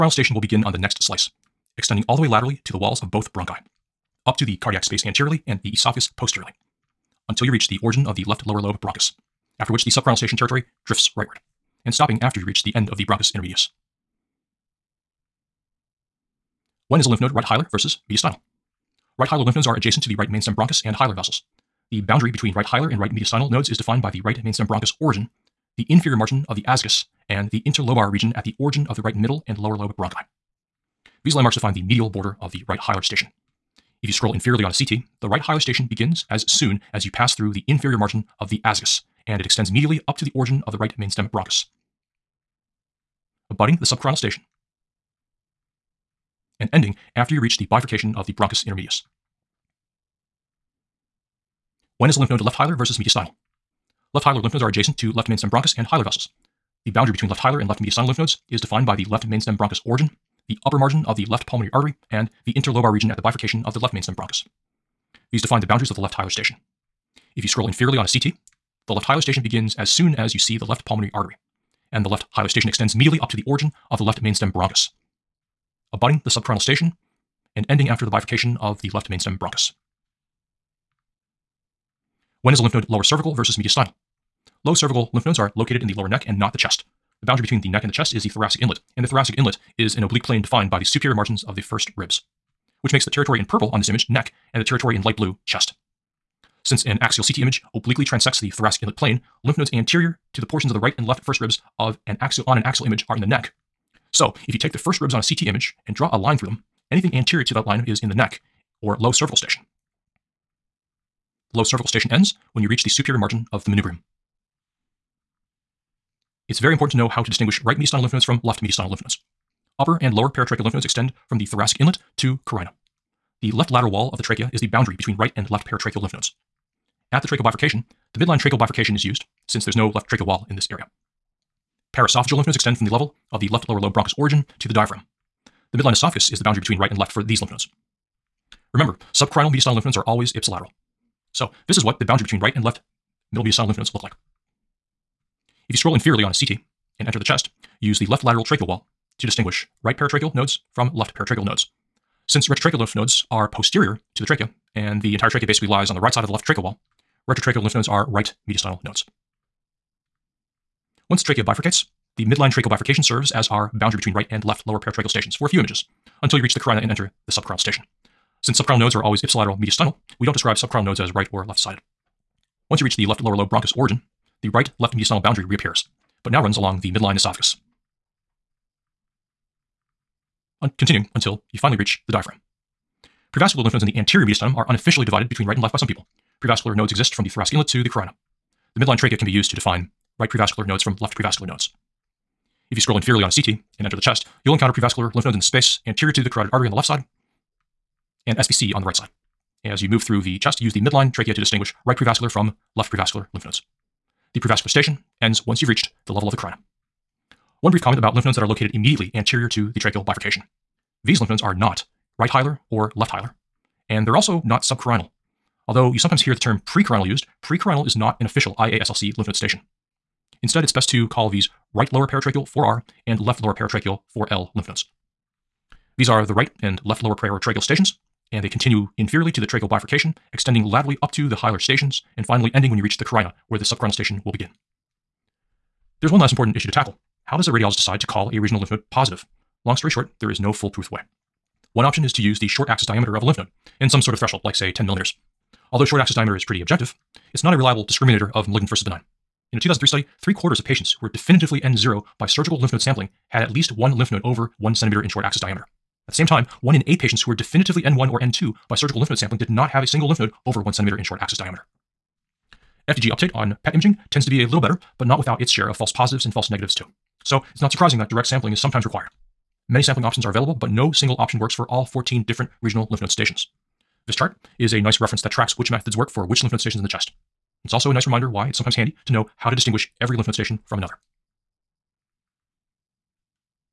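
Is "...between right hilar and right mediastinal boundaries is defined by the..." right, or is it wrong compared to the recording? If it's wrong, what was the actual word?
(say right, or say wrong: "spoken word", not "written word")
wrong: "nodes", not "boundaries".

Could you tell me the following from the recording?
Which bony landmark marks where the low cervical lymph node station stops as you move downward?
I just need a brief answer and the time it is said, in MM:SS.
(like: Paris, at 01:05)
superior margin of the manubrium, at 01:52.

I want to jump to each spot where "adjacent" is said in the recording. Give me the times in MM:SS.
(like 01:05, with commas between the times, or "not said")
00:19, 00:54.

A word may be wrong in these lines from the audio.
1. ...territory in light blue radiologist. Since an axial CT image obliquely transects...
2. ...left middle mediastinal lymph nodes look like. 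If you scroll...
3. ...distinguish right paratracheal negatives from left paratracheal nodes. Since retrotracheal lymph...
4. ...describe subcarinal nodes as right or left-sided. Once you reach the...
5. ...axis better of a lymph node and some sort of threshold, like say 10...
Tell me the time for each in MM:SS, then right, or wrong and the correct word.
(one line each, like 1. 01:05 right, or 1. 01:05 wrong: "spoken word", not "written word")
1. 01:34 wrong: "chest", not "radiologist"
2. 02:22 right
3. 02:29 wrong: "nodes", not "negatives"
4. 02:50 right
5. 04:02 wrong: "diameter", not "better".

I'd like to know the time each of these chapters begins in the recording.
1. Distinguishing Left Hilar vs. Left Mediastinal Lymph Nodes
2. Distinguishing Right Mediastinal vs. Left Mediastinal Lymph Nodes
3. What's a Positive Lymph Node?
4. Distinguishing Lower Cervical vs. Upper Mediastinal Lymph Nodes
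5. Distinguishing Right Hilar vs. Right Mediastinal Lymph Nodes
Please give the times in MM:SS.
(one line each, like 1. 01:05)
1. 00:29
2. 01:54
3. 03:54
4. 00:50
5. 00:15.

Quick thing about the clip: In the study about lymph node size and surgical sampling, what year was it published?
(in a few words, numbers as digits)
2003.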